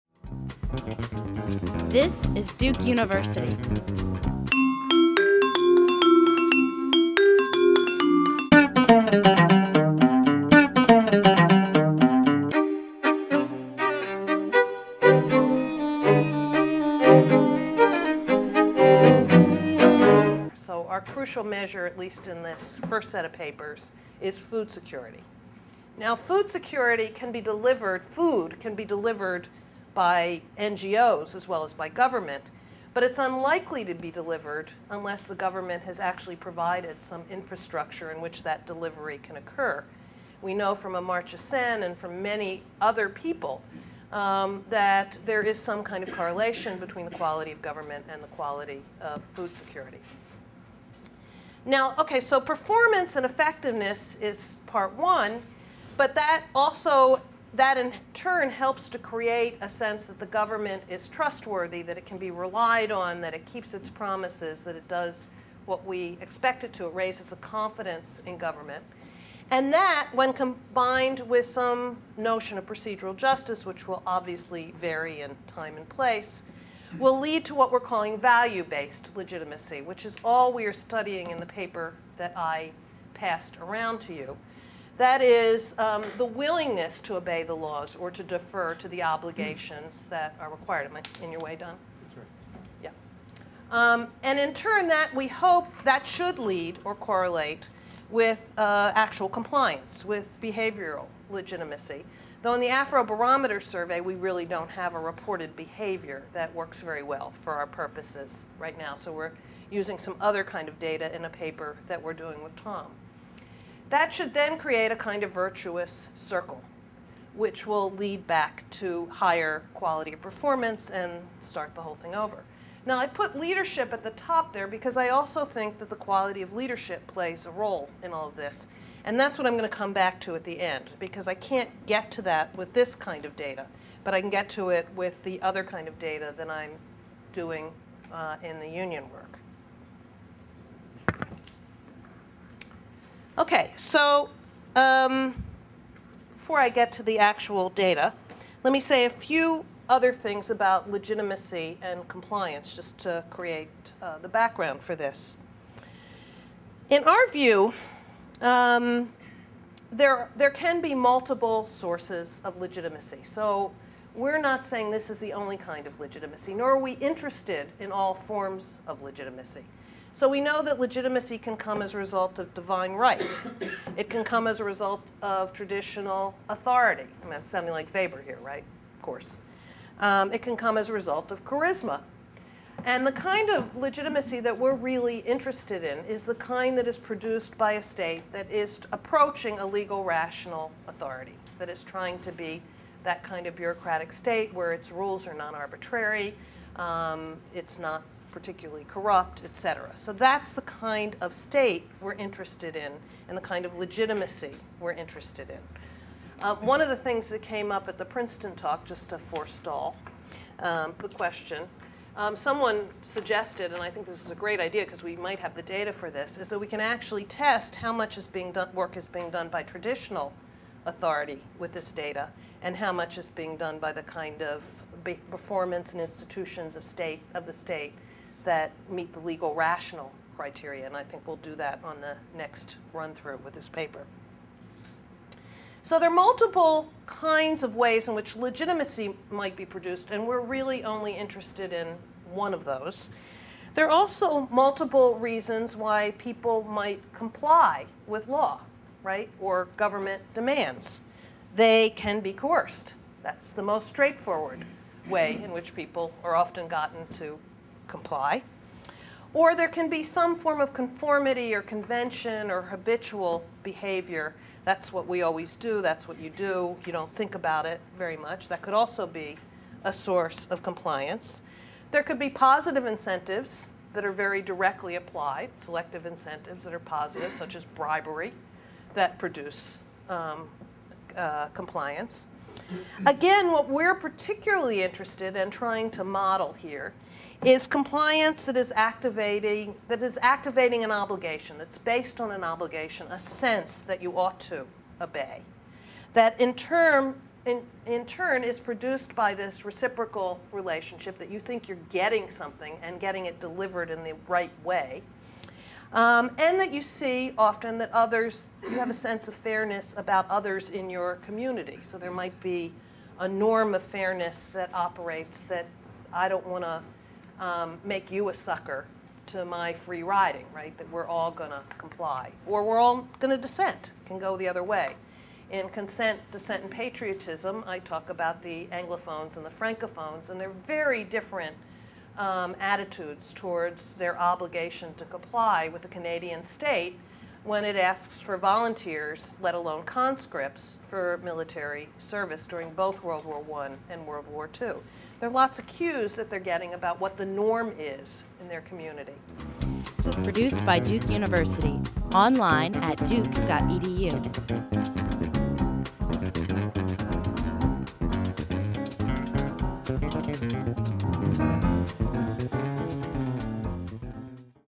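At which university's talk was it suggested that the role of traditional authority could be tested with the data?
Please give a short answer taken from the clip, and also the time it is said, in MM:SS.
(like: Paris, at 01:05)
Princeton, at 03:28.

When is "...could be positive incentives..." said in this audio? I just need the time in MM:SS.
04:32.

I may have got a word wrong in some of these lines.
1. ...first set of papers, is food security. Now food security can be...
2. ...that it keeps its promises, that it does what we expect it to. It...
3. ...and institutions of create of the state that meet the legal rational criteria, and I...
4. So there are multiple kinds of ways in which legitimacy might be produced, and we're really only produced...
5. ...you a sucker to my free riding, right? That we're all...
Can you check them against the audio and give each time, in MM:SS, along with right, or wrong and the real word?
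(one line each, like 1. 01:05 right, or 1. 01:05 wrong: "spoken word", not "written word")
1. 00:22 right
2. 01:03 right
3. 03:45 wrong: "state", not "create"
4. 03:55 wrong: "interested", not "produced"
5. 05:18 right.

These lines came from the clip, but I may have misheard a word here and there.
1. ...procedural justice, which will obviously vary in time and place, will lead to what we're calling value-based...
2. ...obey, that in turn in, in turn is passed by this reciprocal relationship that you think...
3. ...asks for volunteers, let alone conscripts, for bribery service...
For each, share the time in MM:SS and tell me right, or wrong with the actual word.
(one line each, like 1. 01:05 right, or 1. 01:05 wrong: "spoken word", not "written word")
1. 01:12 right
2. 04:55 wrong: "produced", not "passed"
3. 05:37 wrong: "military", not "bribery".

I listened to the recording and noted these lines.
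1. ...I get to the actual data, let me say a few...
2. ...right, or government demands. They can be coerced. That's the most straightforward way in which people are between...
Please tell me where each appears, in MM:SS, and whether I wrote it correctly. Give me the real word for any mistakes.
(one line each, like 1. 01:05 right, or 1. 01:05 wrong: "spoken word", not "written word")
1. 02:26 right
2. 04:09 wrong: "often", not "between".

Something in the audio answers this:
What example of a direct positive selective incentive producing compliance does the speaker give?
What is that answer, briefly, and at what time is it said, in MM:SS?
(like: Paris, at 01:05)
Bribery, at 04:37.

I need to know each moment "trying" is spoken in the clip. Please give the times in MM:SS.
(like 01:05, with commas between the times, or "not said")
03:11, 04:45.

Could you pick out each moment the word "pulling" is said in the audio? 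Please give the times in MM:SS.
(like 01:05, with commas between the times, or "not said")
not said.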